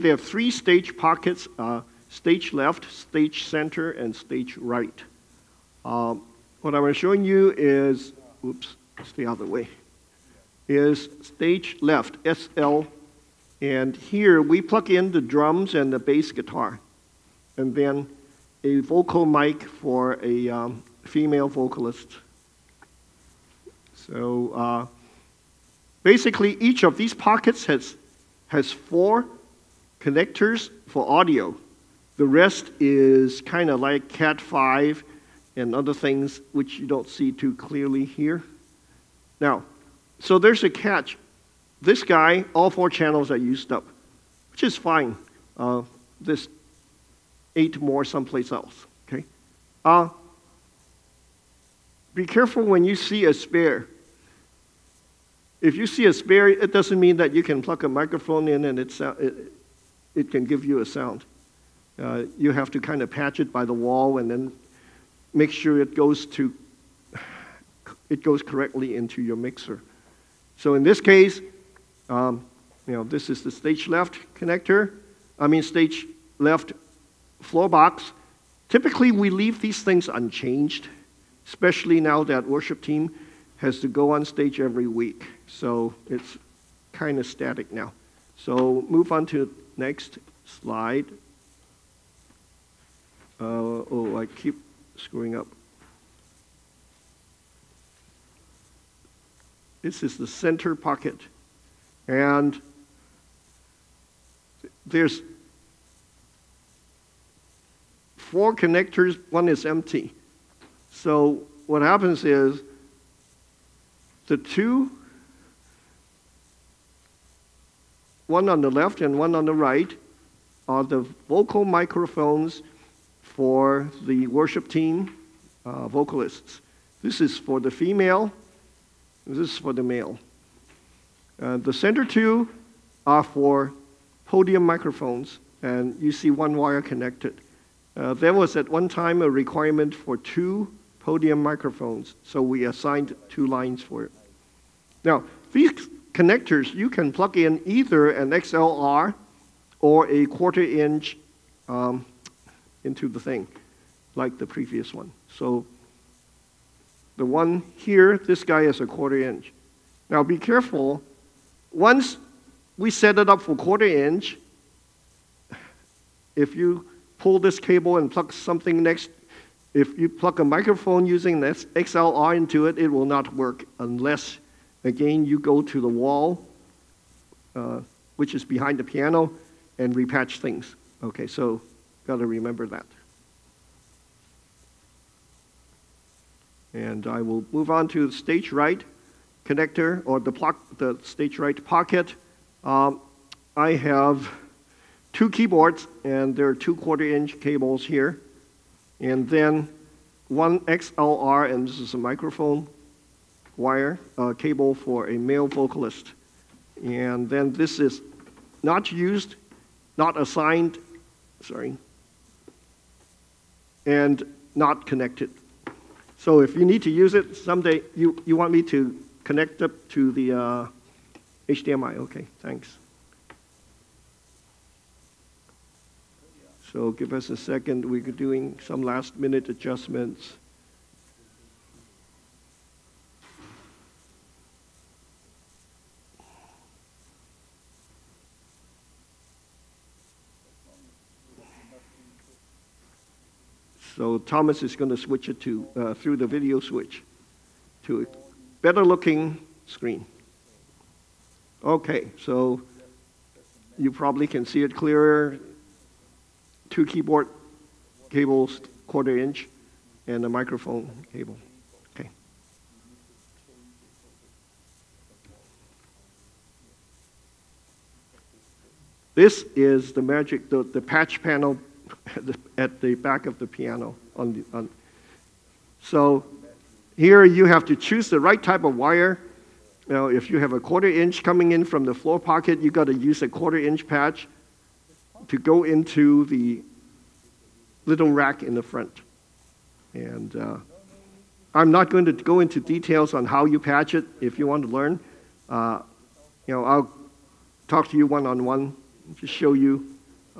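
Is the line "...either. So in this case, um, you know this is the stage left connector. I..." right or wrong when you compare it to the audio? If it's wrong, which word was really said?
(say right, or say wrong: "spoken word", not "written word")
wrong: "mixer", not "either".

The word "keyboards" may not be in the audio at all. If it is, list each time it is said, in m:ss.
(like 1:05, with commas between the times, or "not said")
3:15, 4:16.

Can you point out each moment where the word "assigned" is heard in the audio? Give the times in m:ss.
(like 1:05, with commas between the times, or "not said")
2:22, 3:30.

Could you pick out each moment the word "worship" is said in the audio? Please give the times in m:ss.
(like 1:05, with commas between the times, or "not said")
1:22, 2:04.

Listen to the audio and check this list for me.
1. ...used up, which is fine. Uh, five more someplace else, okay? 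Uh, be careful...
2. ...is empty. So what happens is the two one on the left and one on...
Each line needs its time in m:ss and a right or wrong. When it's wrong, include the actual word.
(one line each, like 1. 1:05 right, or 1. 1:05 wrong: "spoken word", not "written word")
1. 0:43 wrong: "eight", not "five"
2. 1:49 right.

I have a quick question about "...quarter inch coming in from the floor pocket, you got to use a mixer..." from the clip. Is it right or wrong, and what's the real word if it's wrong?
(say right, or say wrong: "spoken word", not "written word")
wrong: "quarter", not "mixer".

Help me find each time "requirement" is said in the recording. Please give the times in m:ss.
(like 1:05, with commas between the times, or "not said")
2:19.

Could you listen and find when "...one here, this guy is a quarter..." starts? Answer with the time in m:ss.
2:37.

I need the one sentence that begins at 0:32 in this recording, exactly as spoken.
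The rest is kind of like Cat5 and other things which you don't see too clearly here.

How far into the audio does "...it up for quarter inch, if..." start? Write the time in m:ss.
2:43.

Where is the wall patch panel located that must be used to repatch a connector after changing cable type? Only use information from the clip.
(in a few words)
Behind the piano.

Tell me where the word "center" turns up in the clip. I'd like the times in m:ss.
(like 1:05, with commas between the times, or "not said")
0:03, 1:40, 2:11.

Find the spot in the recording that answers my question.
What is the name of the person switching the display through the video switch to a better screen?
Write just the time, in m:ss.
4:04.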